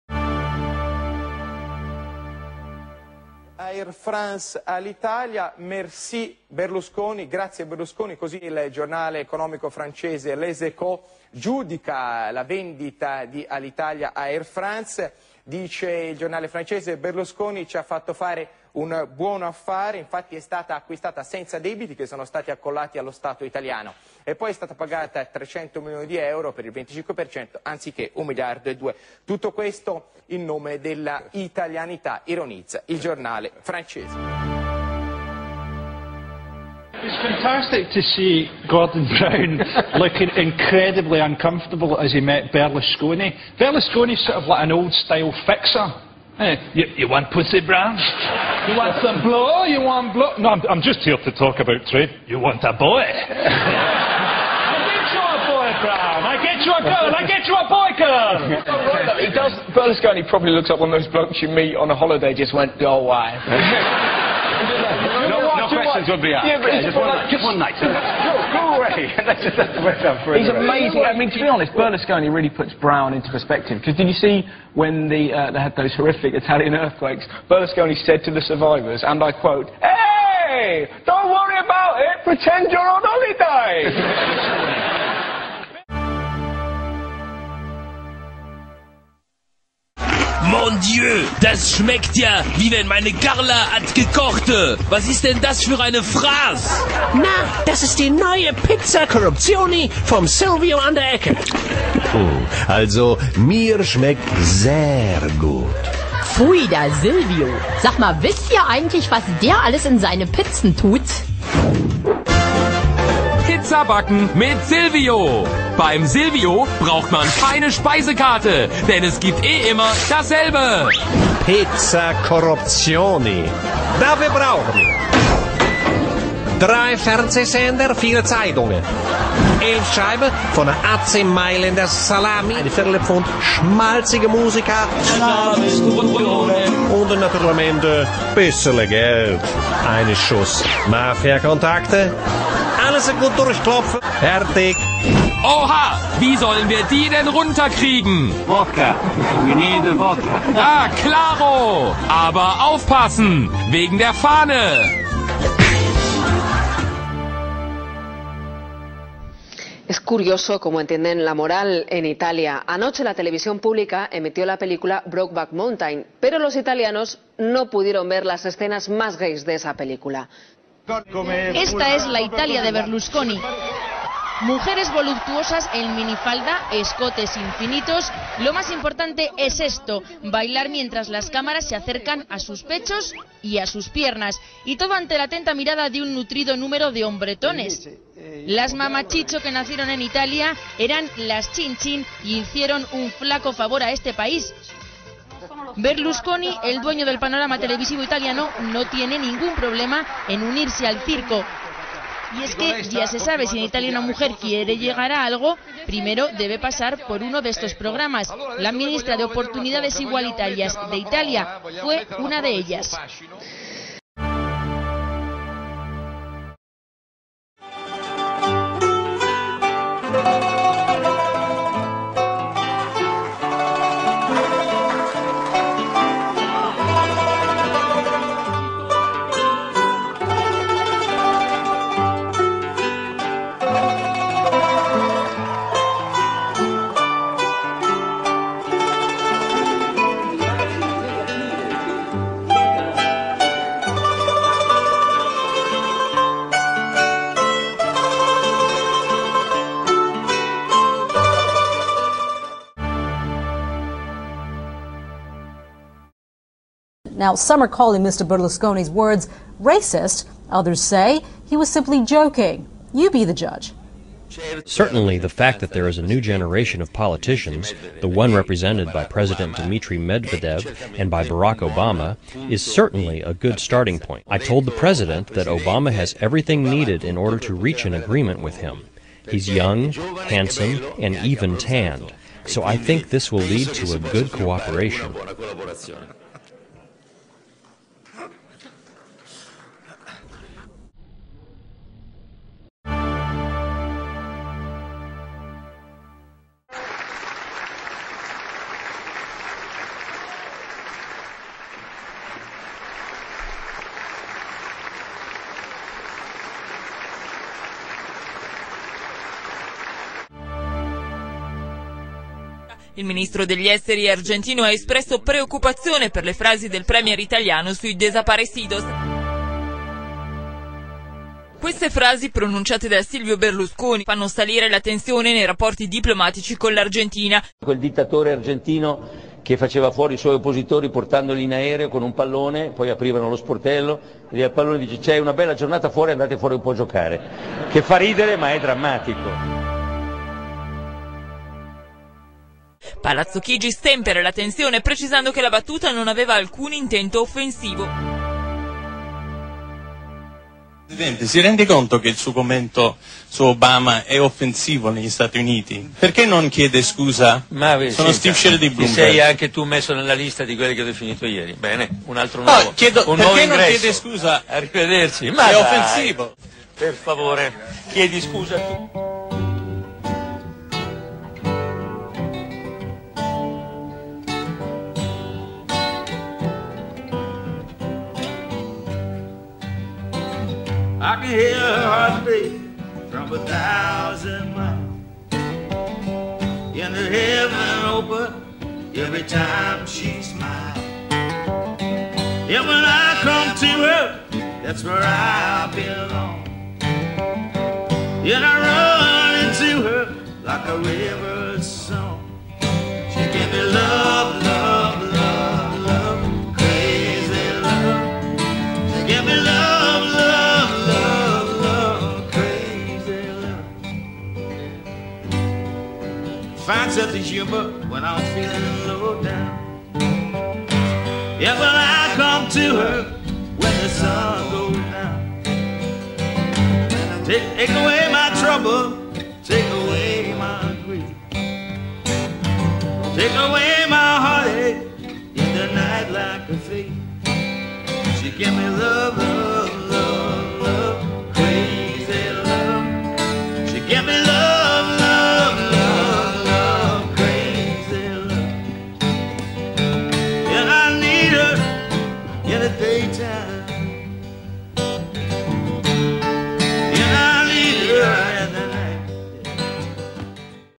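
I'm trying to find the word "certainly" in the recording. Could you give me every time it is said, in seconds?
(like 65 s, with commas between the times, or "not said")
264 s, 272 s.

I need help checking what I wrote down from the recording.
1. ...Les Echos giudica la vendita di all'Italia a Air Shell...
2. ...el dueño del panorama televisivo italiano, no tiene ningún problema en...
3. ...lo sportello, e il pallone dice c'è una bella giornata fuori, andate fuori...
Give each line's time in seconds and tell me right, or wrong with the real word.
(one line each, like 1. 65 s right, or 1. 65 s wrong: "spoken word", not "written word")
1. 10 s wrong: "France", not "Shell"
2. 196 s right
3. 333 s right.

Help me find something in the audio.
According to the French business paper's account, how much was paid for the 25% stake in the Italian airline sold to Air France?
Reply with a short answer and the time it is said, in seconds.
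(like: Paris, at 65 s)
300 million euros, at 25 s.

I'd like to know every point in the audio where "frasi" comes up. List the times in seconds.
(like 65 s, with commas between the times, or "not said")
316 s, 321 s.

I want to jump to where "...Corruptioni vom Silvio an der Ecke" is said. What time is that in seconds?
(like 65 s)
99 s.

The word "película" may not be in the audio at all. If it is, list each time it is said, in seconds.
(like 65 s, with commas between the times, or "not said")
164 s, 169 s.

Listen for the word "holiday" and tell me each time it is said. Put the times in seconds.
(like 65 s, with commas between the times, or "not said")
61 s, 83 s.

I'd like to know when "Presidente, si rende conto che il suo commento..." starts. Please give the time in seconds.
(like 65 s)
350 s.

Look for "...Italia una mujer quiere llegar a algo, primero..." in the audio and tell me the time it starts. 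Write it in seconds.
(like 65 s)
203 s.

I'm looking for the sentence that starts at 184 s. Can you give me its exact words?
Y todo ante la atenta mirada de un nutrido número de hombretones.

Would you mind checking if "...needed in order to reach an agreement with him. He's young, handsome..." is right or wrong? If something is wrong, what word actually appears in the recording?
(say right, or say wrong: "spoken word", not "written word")
right.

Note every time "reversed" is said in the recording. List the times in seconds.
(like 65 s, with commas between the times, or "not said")
not said.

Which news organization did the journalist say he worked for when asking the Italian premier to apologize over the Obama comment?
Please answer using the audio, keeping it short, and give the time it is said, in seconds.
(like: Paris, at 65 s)
Bloomberg, at 358 s.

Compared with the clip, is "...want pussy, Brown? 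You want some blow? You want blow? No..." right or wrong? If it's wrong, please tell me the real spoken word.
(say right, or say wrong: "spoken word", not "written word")
right.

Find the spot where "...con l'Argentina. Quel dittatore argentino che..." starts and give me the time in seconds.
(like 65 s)
326 s.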